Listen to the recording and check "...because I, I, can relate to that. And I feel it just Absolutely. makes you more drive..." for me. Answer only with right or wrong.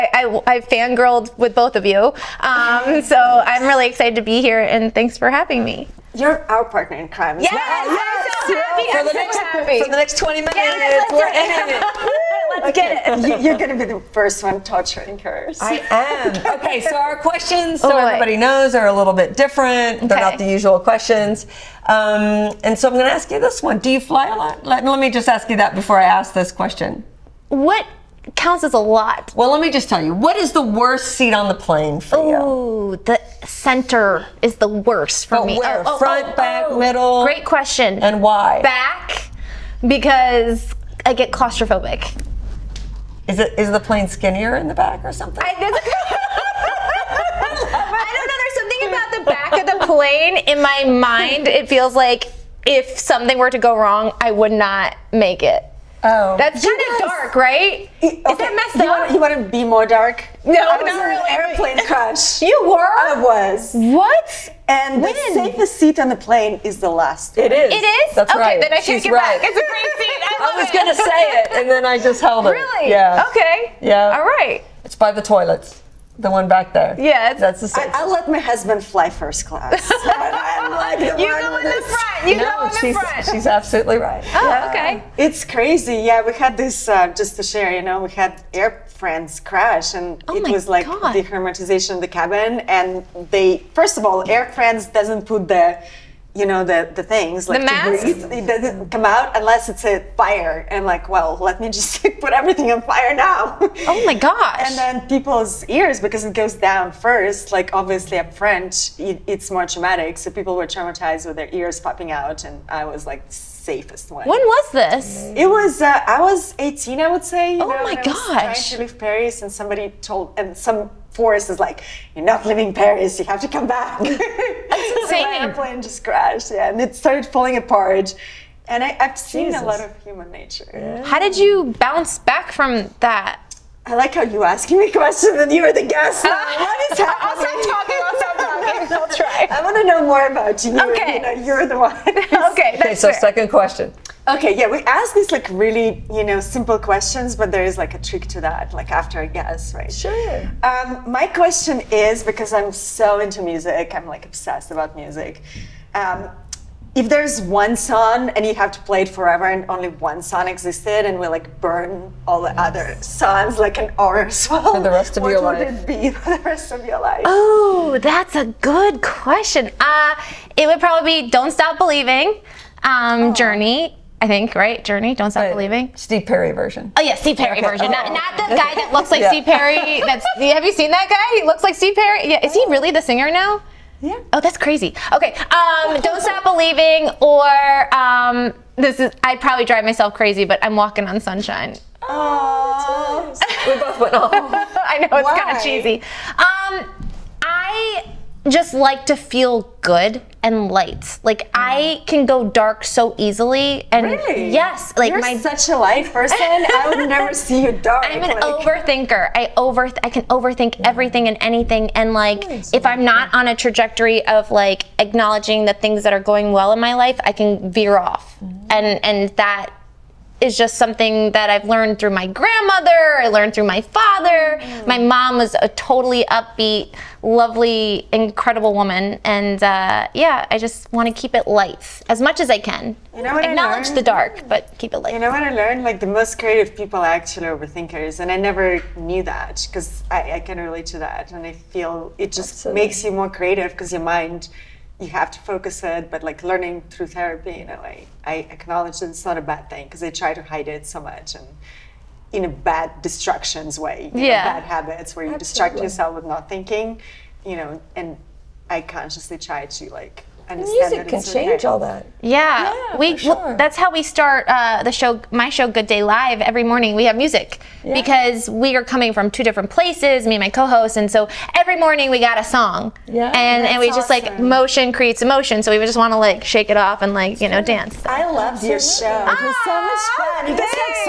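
wrong.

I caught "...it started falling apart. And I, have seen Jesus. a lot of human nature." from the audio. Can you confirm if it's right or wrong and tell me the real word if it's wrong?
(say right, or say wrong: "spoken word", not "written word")
right.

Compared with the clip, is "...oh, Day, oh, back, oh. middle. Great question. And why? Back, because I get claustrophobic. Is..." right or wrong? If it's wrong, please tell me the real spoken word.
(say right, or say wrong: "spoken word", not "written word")
wrong: "Front", not "Day".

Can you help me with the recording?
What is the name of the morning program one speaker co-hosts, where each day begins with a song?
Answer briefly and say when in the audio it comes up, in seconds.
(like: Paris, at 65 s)
Good Day Live, at 265 s.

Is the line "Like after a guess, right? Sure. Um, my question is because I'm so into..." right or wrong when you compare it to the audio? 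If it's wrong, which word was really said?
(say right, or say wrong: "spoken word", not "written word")
right.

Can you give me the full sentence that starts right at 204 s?
yes, like You're my such a light person.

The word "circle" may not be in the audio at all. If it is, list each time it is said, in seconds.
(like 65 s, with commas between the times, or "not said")
not said.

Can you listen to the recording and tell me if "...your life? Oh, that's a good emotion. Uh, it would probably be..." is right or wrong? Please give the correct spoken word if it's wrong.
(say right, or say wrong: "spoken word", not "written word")
wrong: "question", not "emotion".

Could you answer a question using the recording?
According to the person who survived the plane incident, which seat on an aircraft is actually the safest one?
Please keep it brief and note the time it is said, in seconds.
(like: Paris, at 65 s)
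The last one, at 66 s.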